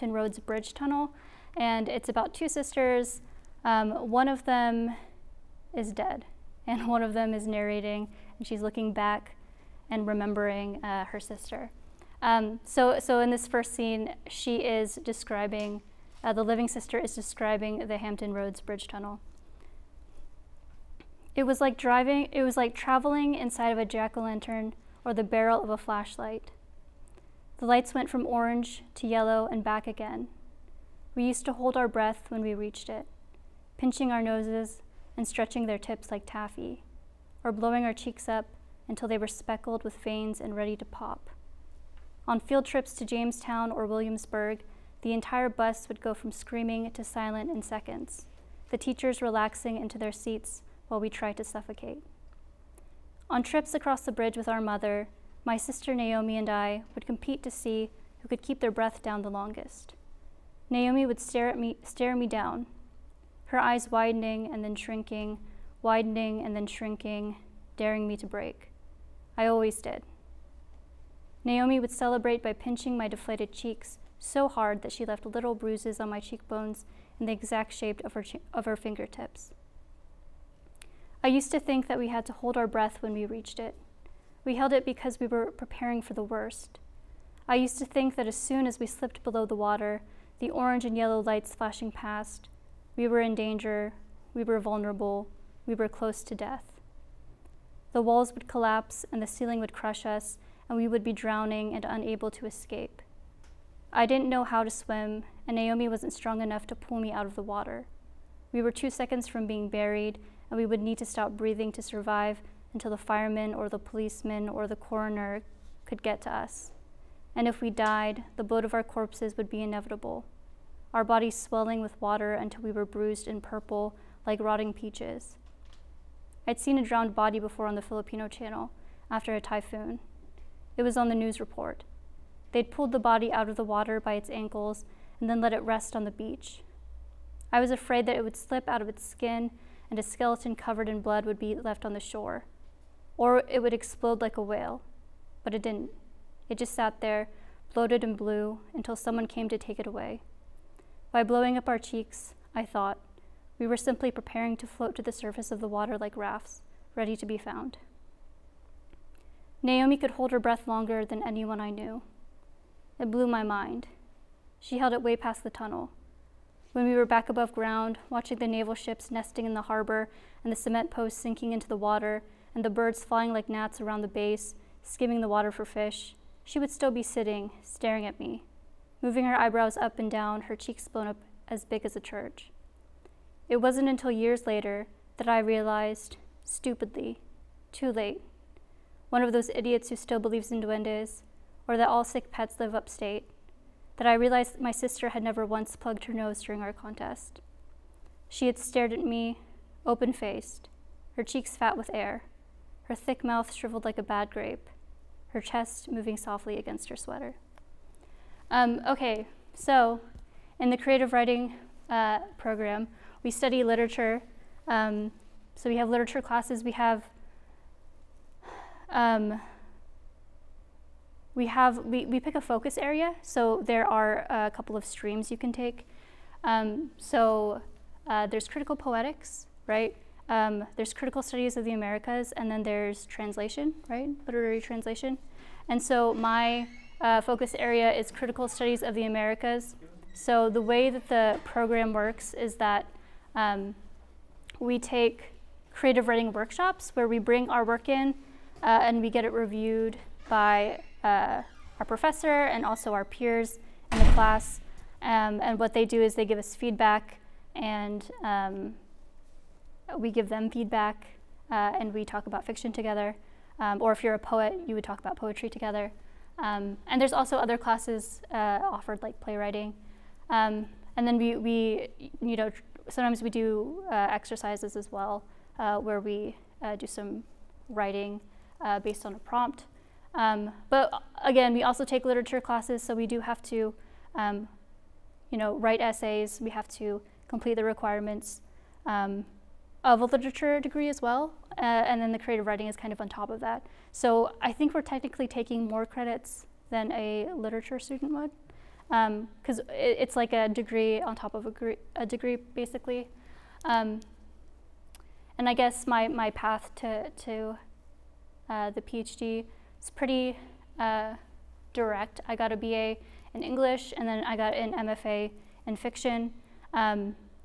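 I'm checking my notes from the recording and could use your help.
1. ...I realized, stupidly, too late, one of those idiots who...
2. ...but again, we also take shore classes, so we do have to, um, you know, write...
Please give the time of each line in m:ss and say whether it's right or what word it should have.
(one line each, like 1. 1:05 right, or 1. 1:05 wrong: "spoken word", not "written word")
1. 3:05 right
2. 4:40 wrong: "literature", not "shore".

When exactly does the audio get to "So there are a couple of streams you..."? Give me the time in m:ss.
3:43.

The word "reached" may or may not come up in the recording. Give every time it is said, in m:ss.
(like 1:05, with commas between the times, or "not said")
0:32, 1:23.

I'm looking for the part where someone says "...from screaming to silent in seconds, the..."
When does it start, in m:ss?
0:46.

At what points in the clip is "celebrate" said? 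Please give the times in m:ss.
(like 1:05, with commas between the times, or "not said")
1:11.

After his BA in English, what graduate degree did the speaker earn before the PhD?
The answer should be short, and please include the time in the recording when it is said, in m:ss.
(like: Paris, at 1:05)
MFA in fiction, at 5:14.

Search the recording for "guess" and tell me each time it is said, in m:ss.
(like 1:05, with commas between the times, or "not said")
5:05.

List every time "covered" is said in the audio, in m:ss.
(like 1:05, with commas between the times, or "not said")
2:20.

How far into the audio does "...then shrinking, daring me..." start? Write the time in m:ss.
1:06.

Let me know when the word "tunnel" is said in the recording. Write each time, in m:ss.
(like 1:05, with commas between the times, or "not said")
0:00, 0:18, 2:45.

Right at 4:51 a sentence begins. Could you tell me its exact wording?
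Uh, and then the creative writing is kind of on top of that.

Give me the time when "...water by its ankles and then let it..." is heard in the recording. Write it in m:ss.
2:13.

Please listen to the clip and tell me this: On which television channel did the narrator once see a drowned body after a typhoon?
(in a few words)
The Filipino channel.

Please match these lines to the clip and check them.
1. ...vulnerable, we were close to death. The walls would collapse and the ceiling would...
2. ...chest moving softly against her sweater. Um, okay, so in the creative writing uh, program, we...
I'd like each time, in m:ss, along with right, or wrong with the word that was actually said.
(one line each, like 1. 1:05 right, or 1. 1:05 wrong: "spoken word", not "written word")
1. 1:34 right
2. 3:25 right.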